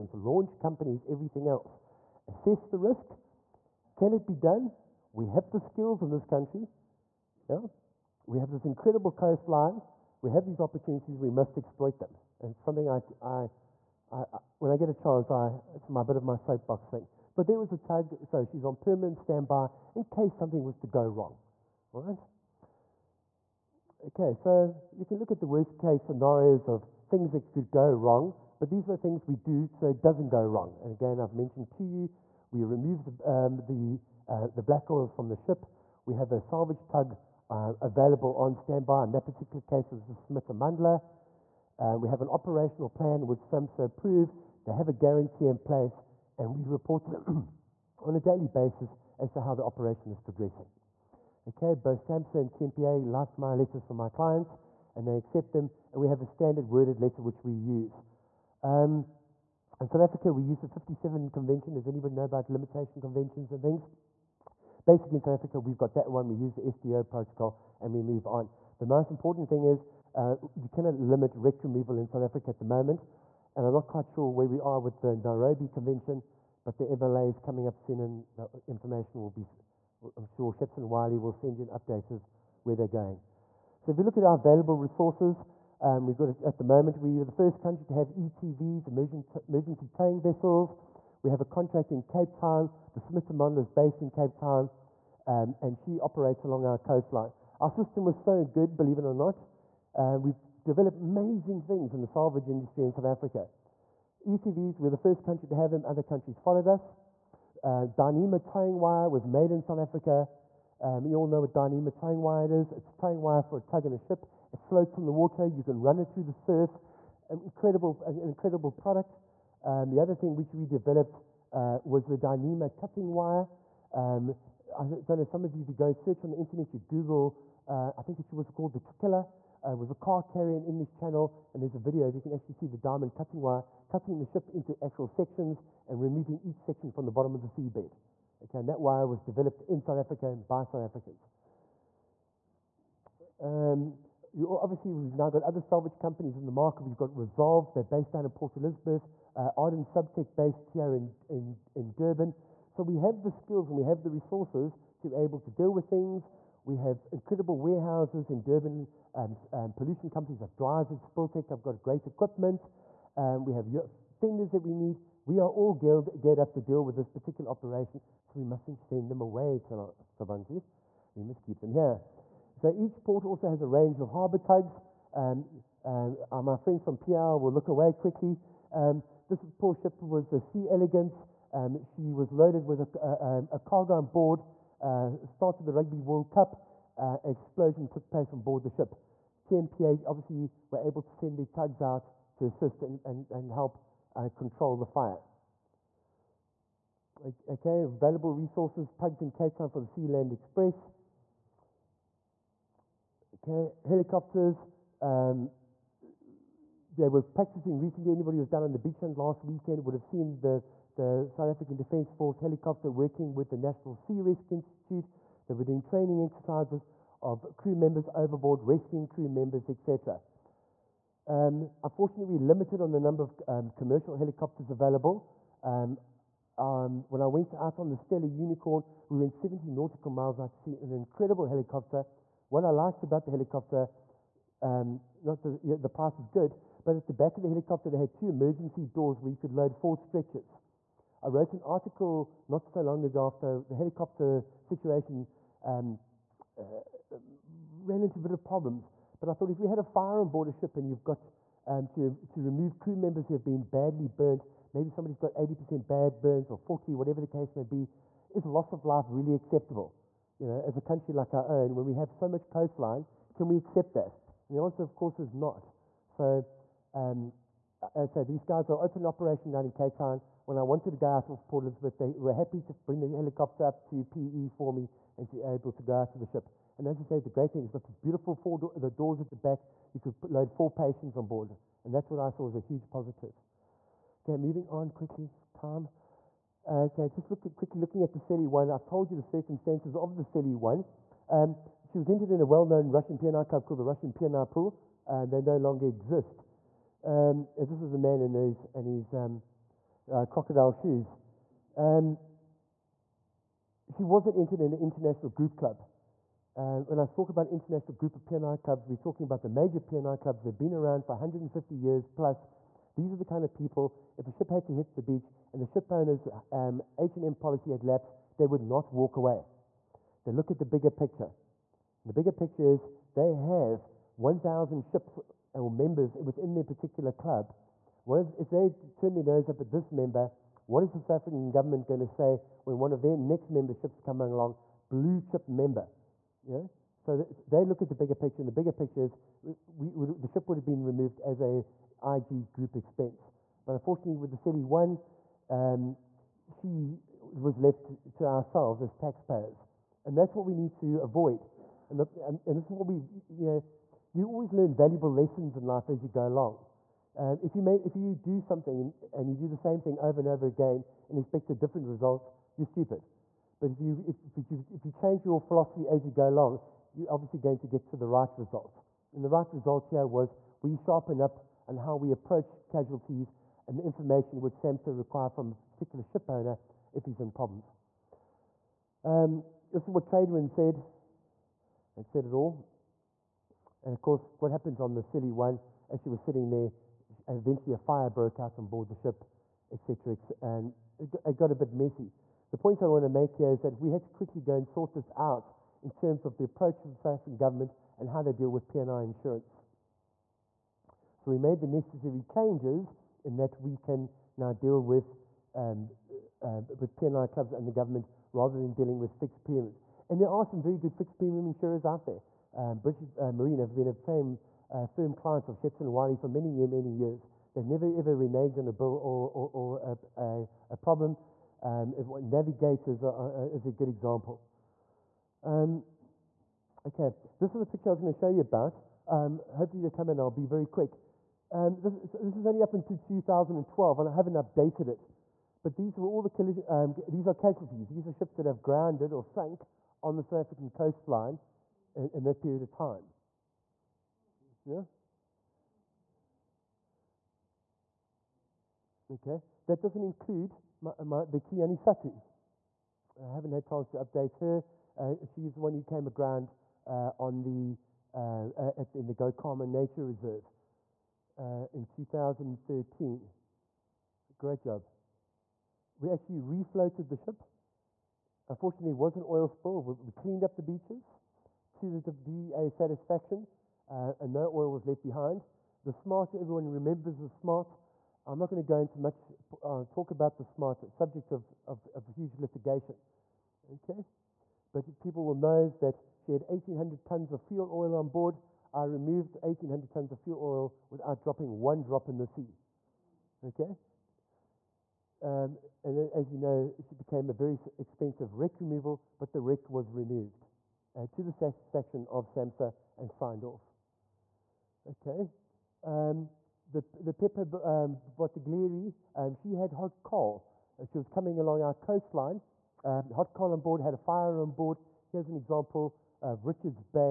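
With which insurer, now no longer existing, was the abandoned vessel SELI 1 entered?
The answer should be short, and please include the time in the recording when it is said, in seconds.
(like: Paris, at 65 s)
Russian P&I Pool, at 293 s.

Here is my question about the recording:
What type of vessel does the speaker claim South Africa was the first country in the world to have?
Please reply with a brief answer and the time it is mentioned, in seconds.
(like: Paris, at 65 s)
Emergency towing vessels, at 89 s.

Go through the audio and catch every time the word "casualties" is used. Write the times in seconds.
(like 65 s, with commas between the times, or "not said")
372 s, 437 s.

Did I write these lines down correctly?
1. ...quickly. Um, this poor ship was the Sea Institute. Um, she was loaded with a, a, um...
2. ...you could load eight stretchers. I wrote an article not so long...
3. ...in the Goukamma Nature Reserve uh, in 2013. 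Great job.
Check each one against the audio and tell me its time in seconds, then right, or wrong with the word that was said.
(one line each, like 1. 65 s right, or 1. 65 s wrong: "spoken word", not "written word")
1. 177 s wrong: "Elegance", not "Institute"
2. 239 s wrong: "four", not "eight"
3. 458 s right.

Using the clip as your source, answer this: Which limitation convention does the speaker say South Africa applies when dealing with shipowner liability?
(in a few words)
57 Convention.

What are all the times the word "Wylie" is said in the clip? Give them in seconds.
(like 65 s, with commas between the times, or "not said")
80 s, 415 s.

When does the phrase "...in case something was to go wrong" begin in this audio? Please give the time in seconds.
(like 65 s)
19 s.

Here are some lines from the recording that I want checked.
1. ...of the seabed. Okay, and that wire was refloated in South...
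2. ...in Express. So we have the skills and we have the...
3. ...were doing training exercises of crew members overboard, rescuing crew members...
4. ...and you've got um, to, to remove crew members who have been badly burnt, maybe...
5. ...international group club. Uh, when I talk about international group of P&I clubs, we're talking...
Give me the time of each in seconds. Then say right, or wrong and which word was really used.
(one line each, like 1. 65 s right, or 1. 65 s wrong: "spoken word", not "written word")
1. 137 s wrong: "developed", not "refloated"
2. 151 s wrong: "Durban", not "Express"
3. 215 s right
4. 250 s right
5. 304 s right.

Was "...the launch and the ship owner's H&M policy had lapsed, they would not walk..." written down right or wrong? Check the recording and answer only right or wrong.
wrong.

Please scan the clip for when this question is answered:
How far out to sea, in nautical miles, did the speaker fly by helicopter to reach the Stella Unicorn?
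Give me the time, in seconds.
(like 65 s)
229 s.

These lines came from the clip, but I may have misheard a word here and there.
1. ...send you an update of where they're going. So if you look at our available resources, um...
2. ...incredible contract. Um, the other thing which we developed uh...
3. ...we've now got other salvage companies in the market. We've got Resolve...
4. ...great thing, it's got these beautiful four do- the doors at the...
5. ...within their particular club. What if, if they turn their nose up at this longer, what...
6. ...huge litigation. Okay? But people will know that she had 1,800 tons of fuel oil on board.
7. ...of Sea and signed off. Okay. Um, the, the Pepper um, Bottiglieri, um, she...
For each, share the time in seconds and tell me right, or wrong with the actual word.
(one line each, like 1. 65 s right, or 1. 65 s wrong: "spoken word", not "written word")
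1. 81 s right
2. 118 s wrong: "product", not "contract"
3. 144 s right
4. 277 s right
5. 326 s wrong: "member", not "longer"
6. 482 s right
7. 502 s wrong: "SAMSA", not "Sea".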